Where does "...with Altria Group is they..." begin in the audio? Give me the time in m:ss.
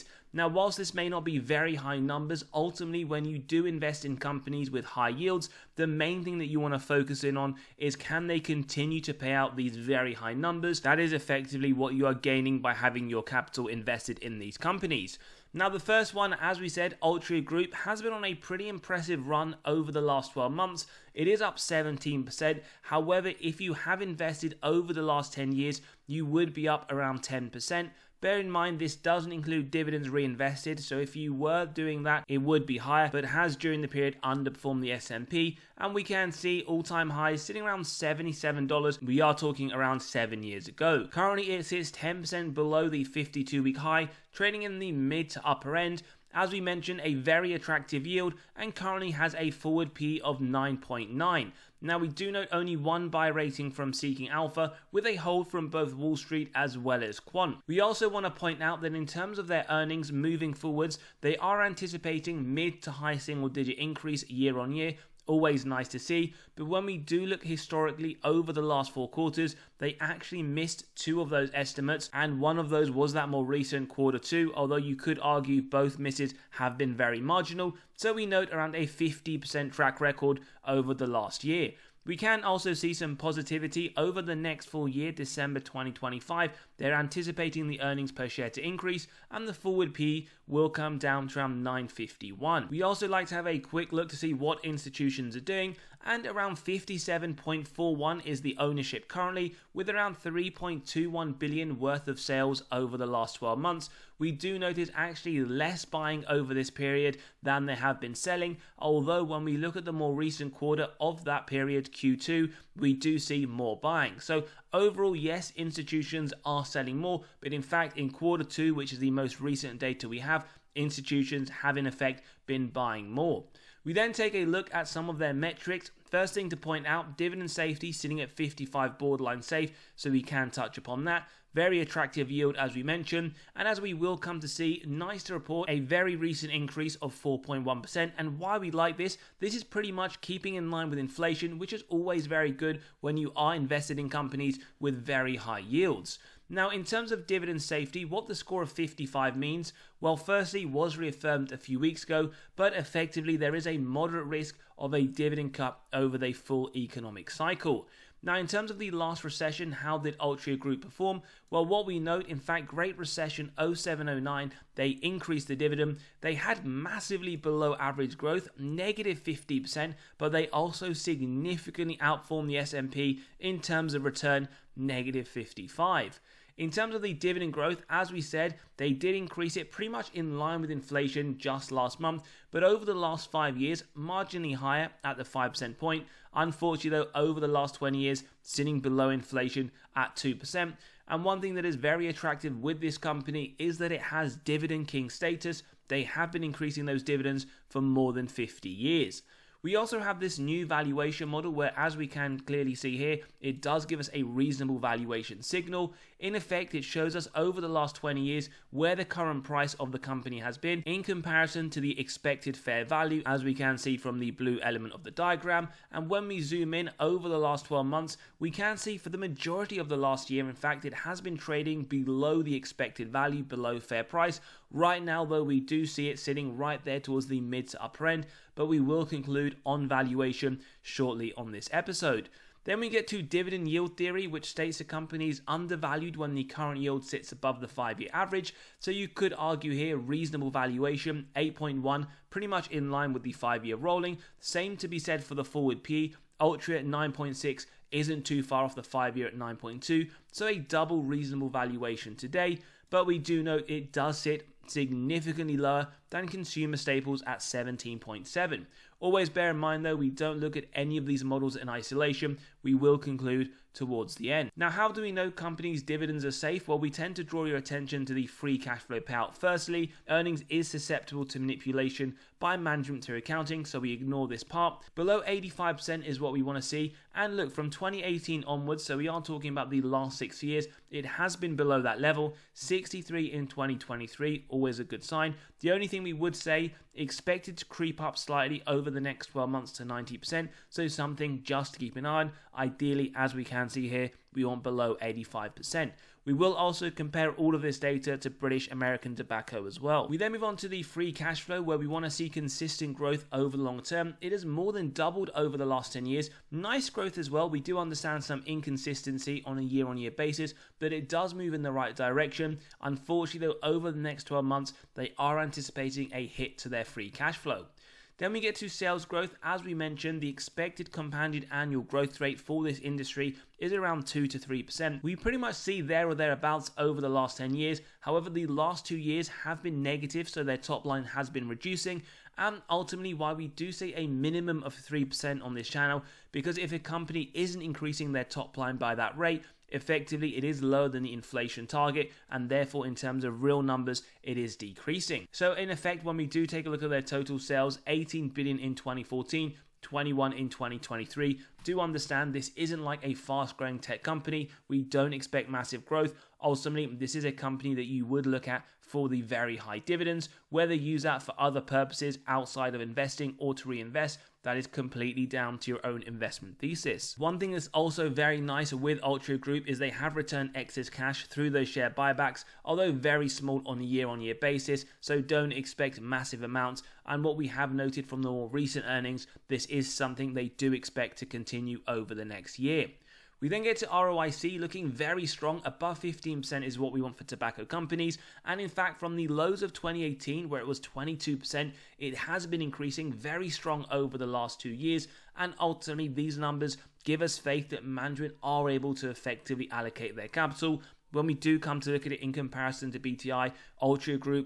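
6:08.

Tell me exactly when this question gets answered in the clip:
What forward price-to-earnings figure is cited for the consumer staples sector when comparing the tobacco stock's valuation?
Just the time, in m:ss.
4:17.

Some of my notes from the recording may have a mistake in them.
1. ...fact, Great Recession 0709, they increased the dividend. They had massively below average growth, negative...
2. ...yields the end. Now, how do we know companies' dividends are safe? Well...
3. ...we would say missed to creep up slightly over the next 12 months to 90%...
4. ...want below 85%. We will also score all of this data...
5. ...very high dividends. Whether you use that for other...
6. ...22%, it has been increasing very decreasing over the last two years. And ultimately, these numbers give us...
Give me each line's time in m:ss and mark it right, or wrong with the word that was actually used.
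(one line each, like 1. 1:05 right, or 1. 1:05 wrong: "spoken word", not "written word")
1. 2:42 right
2. 4:23 wrong: "towards", not "yields"
3. 4:46 wrong: "expected", not "missed"
4. 4:54 wrong: "compare", not "score"
5. 5:59 right
6. 6:30 wrong: "strong", not "decreasing".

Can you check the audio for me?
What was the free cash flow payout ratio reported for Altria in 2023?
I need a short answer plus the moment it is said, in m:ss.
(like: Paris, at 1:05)
63%, at 4:42.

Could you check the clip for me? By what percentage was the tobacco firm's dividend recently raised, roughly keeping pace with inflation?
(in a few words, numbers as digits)
4.1%.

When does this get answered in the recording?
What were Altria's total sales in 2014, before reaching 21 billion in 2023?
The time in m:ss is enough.
5:47.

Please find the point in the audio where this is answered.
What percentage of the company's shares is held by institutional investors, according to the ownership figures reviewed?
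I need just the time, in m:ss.
1:36.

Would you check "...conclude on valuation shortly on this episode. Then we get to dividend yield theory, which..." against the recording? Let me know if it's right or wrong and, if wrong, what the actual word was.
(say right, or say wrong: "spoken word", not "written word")
right.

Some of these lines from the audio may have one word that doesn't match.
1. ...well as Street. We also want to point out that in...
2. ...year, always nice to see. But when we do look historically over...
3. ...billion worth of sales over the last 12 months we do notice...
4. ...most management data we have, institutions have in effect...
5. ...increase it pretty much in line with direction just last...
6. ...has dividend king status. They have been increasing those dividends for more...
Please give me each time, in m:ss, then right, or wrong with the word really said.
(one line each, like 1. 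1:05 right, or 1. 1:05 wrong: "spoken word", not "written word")
1. 0:56 wrong: "Quant", not "Street"
2. 1:04 right
3. 1:41 right
4. 1:59 wrong: "recent", not "management"
5. 2:59 wrong: "inflation", not "direction"
6. 3:14 right.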